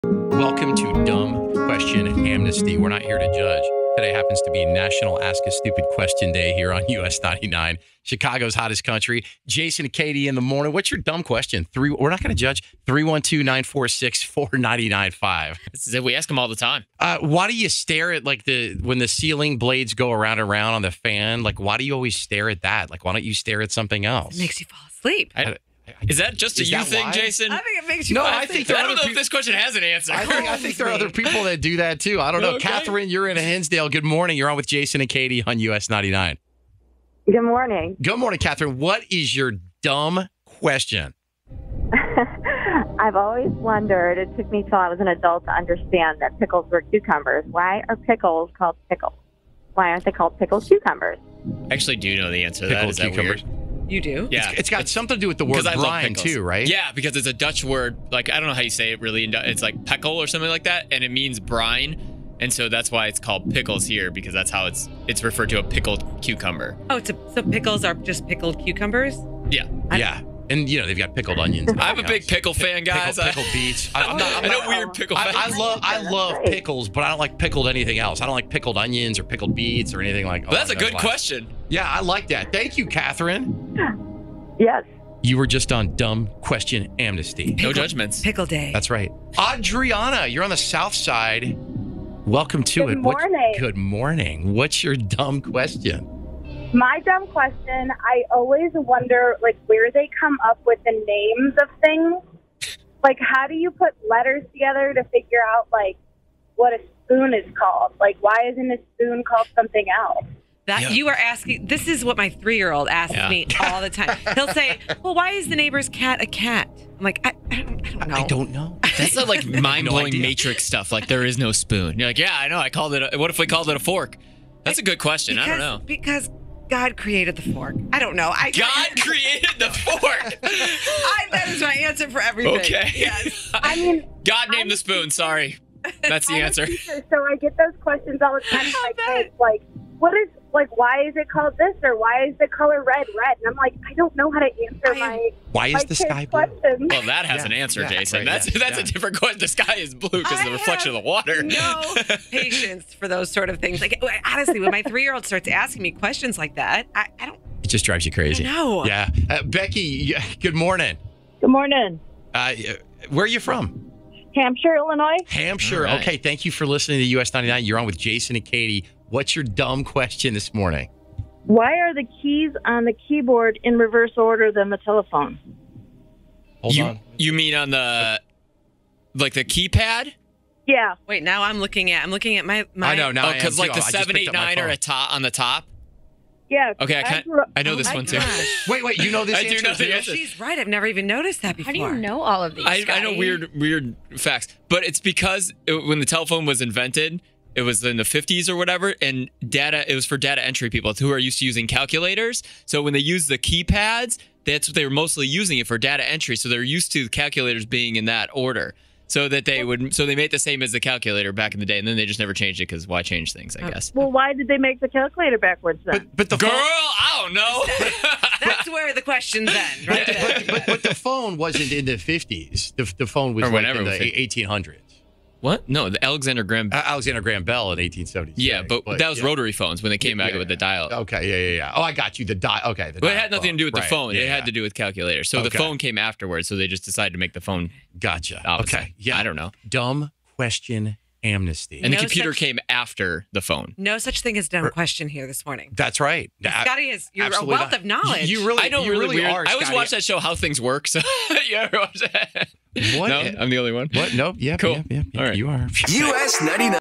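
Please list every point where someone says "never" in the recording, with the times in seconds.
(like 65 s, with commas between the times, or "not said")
190 s, 212 s.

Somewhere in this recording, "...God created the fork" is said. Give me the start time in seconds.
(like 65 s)
126 s.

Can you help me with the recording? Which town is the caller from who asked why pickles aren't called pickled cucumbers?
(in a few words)
Hinsdale.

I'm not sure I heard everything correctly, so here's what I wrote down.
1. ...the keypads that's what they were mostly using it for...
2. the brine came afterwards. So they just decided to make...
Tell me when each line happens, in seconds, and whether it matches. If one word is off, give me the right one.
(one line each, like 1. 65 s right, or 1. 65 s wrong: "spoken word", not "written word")
1. 203 s right
2. 235 s wrong: "phone", not "brine".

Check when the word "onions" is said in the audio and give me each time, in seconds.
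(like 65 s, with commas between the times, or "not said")
71 s, 78 s.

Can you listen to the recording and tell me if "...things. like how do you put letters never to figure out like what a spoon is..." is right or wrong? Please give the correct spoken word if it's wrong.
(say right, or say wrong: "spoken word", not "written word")
wrong: "together", not "never".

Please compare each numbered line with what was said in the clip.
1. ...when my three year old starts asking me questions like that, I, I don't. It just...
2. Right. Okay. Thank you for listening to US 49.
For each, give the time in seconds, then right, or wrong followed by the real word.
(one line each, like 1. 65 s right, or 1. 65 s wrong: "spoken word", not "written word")
1. 154 s right
2. 165 s wrong: "99", not "49".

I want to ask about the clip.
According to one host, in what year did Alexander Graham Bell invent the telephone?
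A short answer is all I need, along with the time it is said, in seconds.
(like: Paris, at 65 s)
1870, at 227 s.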